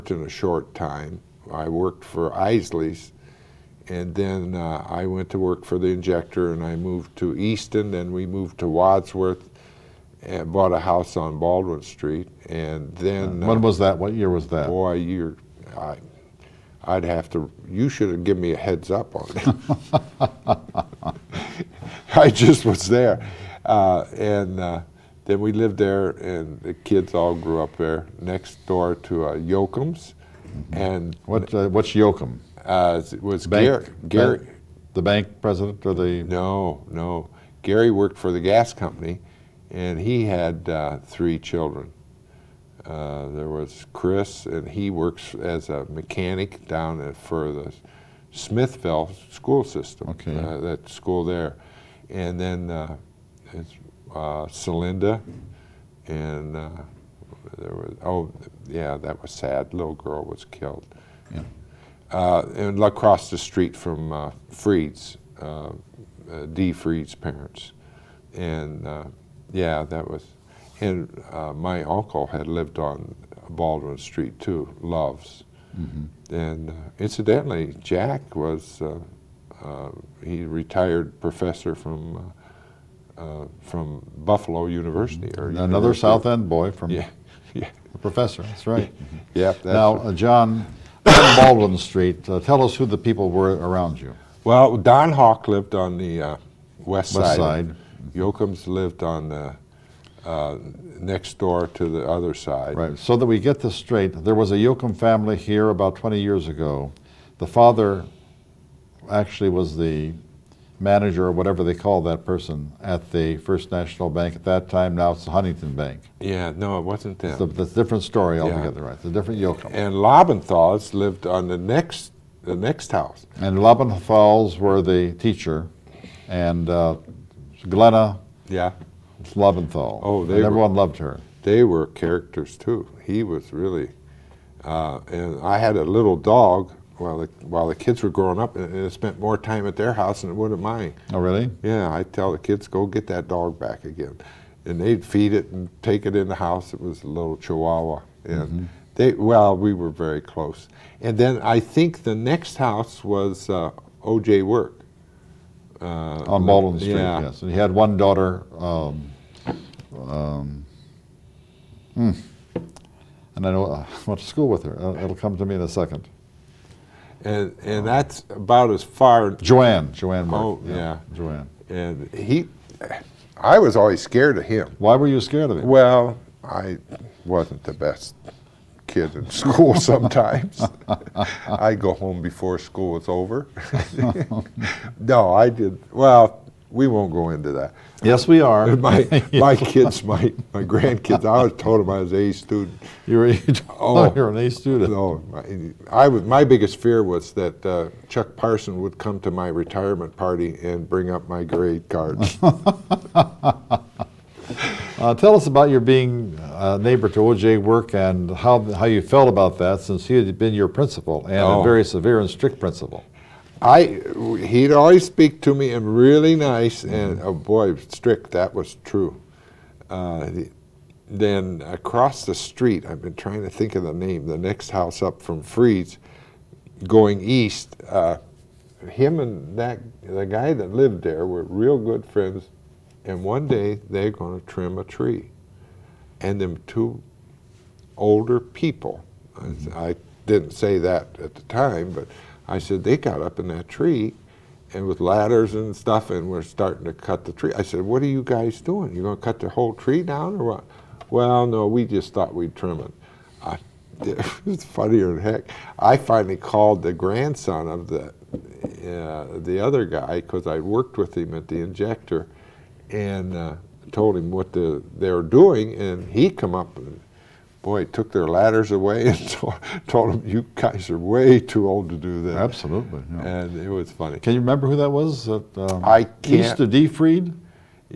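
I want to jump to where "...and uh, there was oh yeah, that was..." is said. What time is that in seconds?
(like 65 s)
56 s.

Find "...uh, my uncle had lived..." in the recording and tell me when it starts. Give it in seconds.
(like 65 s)
71 s.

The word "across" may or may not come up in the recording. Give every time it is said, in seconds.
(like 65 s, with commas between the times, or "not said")
62 s, 221 s.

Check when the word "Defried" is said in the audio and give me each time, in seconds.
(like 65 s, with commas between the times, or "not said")
276 s.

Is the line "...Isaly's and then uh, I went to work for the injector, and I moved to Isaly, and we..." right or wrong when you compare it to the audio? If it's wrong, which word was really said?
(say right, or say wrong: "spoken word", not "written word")
wrong: "Easton", not "Isaly".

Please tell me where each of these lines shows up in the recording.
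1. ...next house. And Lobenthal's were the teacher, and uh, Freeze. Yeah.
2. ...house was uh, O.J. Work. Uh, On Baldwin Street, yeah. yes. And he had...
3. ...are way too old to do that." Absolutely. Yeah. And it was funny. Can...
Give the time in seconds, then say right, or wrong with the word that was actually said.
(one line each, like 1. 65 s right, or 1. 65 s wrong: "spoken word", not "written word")
1. 122 s wrong: "Glenna", not "Freeze"
2. 152 s right
3. 270 s right.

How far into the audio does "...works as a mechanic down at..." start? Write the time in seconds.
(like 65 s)
44 s.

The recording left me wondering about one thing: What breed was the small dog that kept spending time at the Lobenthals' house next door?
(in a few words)
chihuahua.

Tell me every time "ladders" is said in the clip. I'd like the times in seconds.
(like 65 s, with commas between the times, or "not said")
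244 s, 268 s.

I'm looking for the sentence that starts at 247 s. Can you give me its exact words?
I said, what are you guys doing?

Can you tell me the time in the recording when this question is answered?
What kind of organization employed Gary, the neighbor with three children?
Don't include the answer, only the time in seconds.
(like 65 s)
38 s.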